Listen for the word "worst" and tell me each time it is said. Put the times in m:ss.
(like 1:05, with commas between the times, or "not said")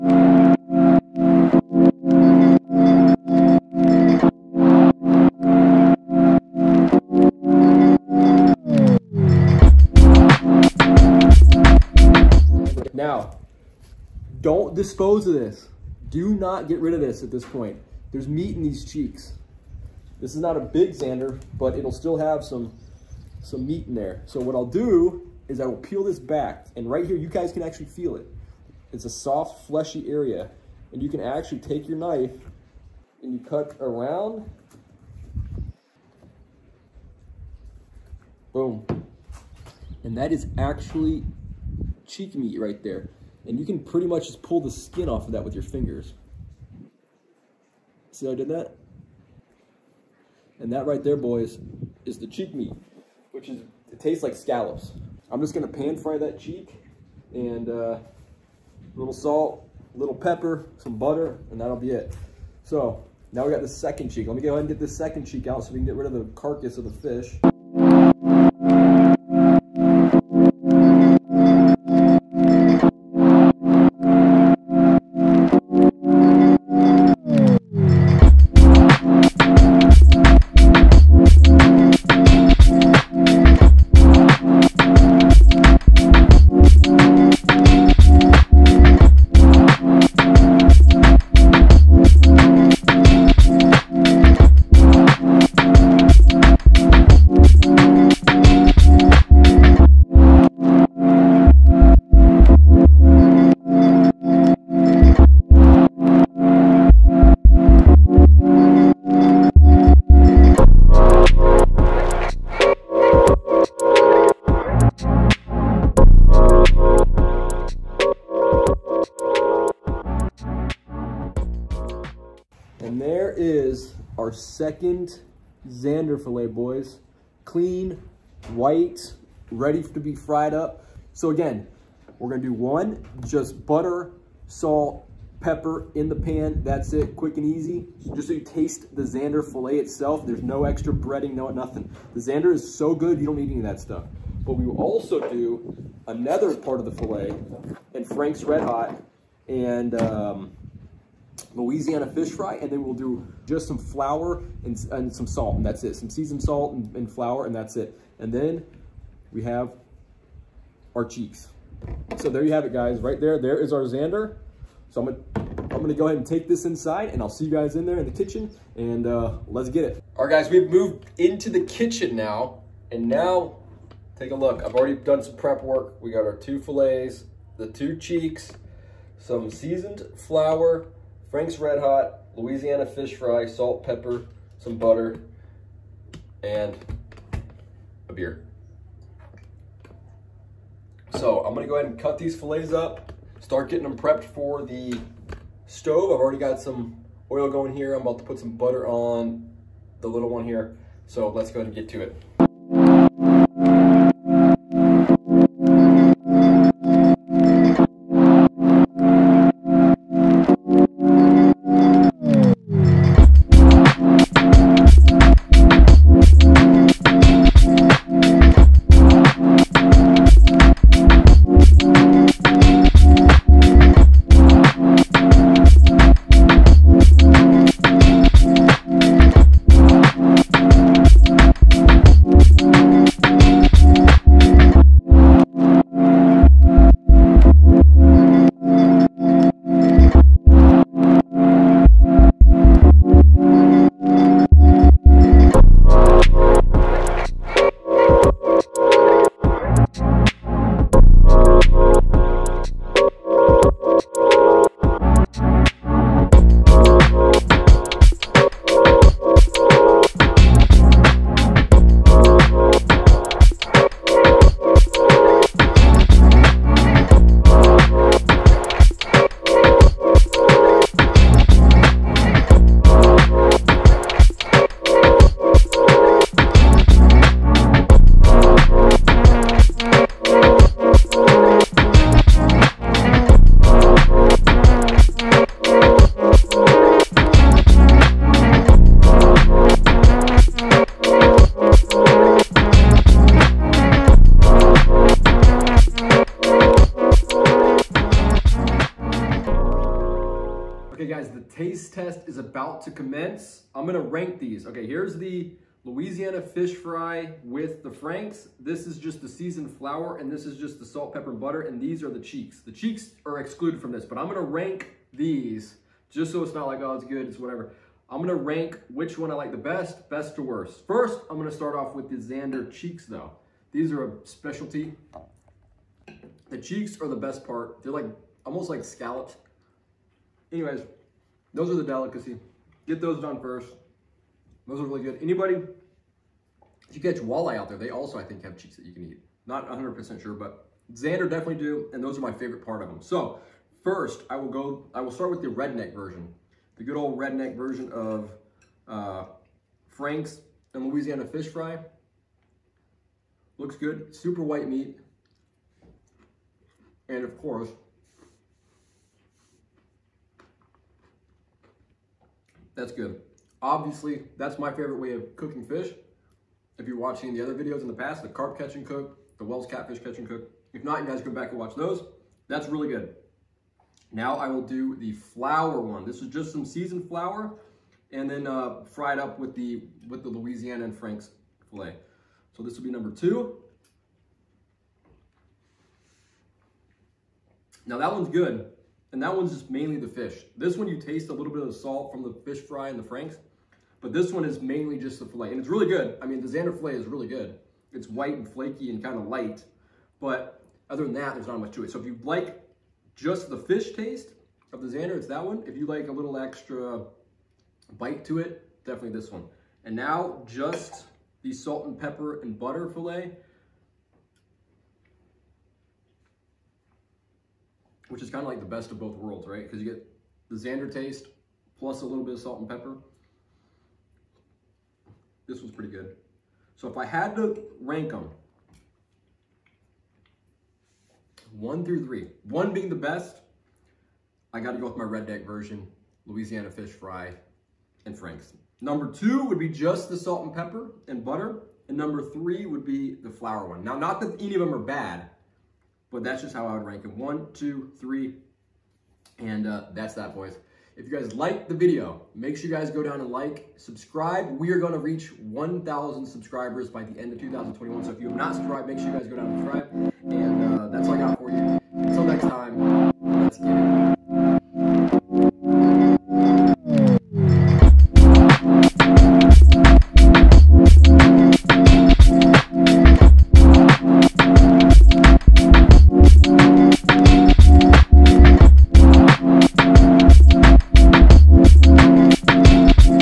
5:20.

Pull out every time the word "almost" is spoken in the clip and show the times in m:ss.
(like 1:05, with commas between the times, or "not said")
5:28.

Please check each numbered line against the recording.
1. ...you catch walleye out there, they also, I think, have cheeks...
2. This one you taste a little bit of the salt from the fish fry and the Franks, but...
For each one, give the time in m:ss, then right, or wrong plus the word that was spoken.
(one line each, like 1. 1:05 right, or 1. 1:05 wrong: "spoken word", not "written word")
1. 5:36 right
2. 6:30 right.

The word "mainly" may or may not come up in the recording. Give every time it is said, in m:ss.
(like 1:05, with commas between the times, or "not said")
6:29, 6:34.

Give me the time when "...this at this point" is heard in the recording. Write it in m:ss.
0:16.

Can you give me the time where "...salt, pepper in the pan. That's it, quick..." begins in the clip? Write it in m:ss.
2:14.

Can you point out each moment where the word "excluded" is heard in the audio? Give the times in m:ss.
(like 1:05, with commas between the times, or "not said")
5:13.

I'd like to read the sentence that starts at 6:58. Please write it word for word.
which is kind of like the best of both worlds, right?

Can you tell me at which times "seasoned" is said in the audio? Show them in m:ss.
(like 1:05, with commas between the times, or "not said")
2:36, 2:59, 5:09, 6:16.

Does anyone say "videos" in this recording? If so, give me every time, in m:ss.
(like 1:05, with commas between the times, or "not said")
6:07, 7:31.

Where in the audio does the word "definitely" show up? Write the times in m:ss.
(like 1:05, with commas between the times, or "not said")
5:41, 6:48.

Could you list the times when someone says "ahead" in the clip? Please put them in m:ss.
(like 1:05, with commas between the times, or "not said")
1:04, 2:46, 3:11, 3:21.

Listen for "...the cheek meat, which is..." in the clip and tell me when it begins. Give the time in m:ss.
0:52.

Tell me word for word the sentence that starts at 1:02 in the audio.
So now we got the second cheek.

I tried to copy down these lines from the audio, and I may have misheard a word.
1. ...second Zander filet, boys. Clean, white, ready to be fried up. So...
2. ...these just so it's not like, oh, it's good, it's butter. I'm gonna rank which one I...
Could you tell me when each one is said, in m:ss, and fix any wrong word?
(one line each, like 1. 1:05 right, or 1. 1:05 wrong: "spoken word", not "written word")
1. 2:04 right
2. 5:15 wrong: "whatever", not "butter".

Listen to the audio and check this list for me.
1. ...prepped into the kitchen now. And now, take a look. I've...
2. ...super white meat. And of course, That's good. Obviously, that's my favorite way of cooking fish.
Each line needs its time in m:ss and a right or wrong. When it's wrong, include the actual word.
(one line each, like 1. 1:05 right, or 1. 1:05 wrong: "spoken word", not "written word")
1. 2:50 wrong: "moved", not "prepped"
2. 5:54 right.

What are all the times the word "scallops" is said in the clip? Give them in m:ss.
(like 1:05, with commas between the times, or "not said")
0:54, 5:28.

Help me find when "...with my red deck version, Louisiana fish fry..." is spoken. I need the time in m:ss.
7:14.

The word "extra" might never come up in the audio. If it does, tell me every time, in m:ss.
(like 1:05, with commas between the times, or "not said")
2:20, 6:46.